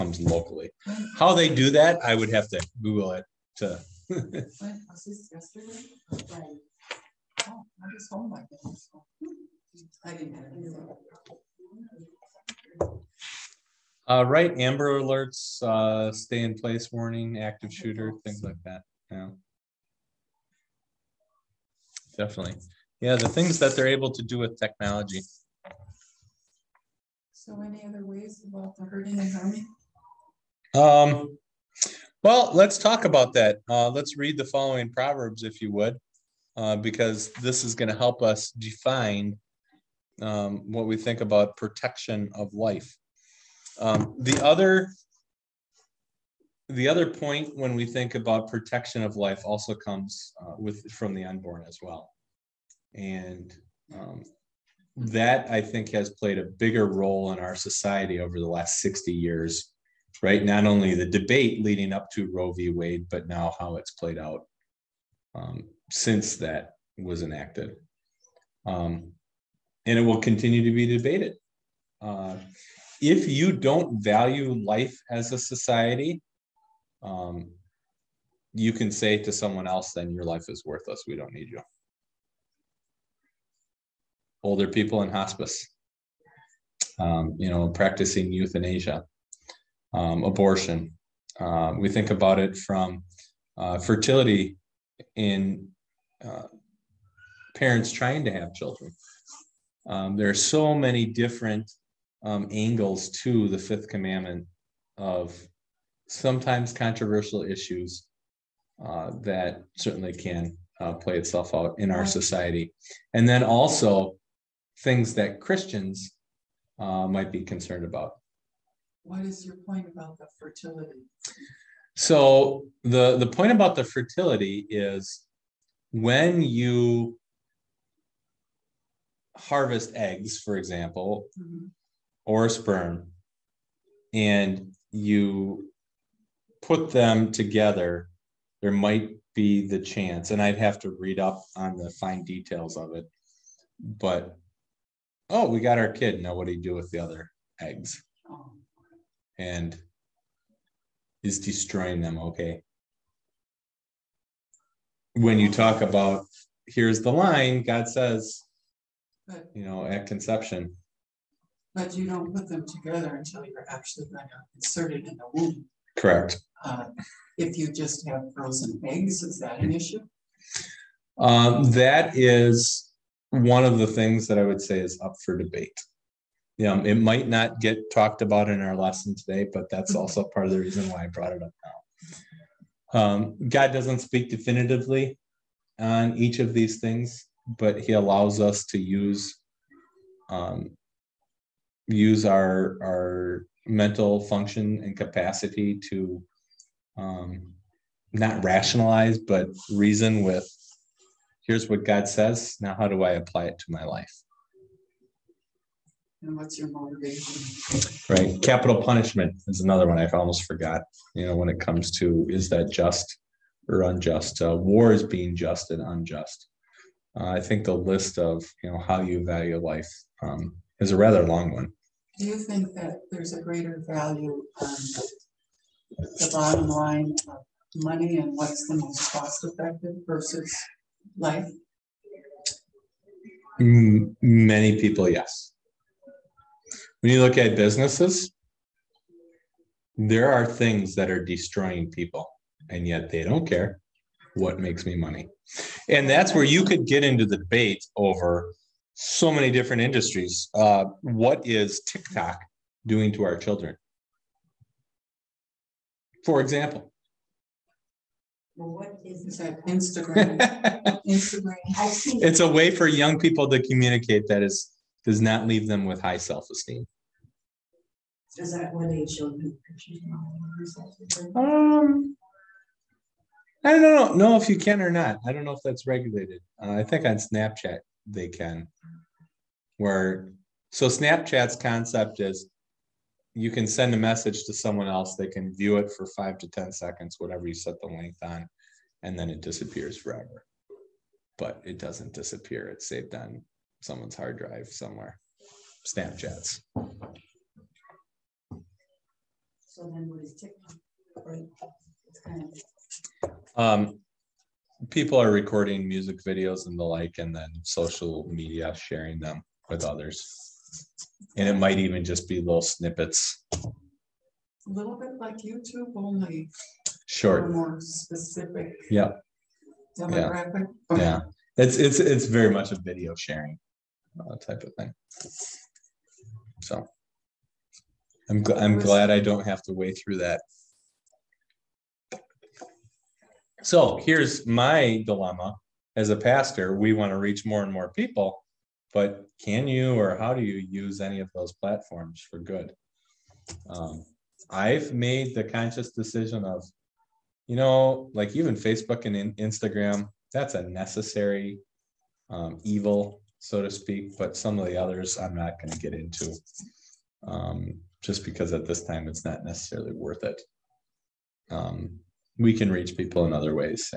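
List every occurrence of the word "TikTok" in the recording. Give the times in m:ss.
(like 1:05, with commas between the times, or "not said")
4:11, 5:00.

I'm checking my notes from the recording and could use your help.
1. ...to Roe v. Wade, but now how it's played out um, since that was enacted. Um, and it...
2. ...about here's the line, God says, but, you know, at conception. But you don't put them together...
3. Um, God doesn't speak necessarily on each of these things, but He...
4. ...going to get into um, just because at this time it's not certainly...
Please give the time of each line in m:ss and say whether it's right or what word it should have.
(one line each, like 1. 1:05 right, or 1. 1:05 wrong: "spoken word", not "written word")
1. 1:02 right
2. 2:35 right
3. 3:02 wrong: "definitively", not "necessarily"
4. 5:55 wrong: "necessarily", not "certainly".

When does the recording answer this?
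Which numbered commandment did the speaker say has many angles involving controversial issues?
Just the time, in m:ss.
1:43.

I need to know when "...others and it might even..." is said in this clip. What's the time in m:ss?
5:09.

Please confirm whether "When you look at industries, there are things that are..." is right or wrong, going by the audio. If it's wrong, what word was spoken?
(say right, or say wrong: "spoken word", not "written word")
wrong: "businesses", not "industries".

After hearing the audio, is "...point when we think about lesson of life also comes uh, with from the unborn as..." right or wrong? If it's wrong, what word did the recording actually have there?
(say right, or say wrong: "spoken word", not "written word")
wrong: "protection", not "lesson".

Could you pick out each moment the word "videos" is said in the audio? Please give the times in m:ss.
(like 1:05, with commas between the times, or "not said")
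5:06, 5:22.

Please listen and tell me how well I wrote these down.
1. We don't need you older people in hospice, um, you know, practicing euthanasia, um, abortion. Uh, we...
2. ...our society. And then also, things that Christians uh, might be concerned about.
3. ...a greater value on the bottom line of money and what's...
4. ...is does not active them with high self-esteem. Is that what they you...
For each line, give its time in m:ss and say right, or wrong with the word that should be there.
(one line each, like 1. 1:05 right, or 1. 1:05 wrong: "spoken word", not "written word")
1. 1:21 right
2. 1:51 right
3. 3:43 right
4. 4:24 wrong: "leave", not "active".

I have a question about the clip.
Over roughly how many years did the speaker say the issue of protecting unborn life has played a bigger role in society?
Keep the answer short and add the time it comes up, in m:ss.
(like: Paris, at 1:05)
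60 years, at 0:58.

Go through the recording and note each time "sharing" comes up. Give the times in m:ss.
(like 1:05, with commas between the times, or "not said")
5:08, 5:23.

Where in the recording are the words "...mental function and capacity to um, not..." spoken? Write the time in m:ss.
3:13.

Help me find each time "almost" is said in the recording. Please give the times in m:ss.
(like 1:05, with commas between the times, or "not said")
3:30.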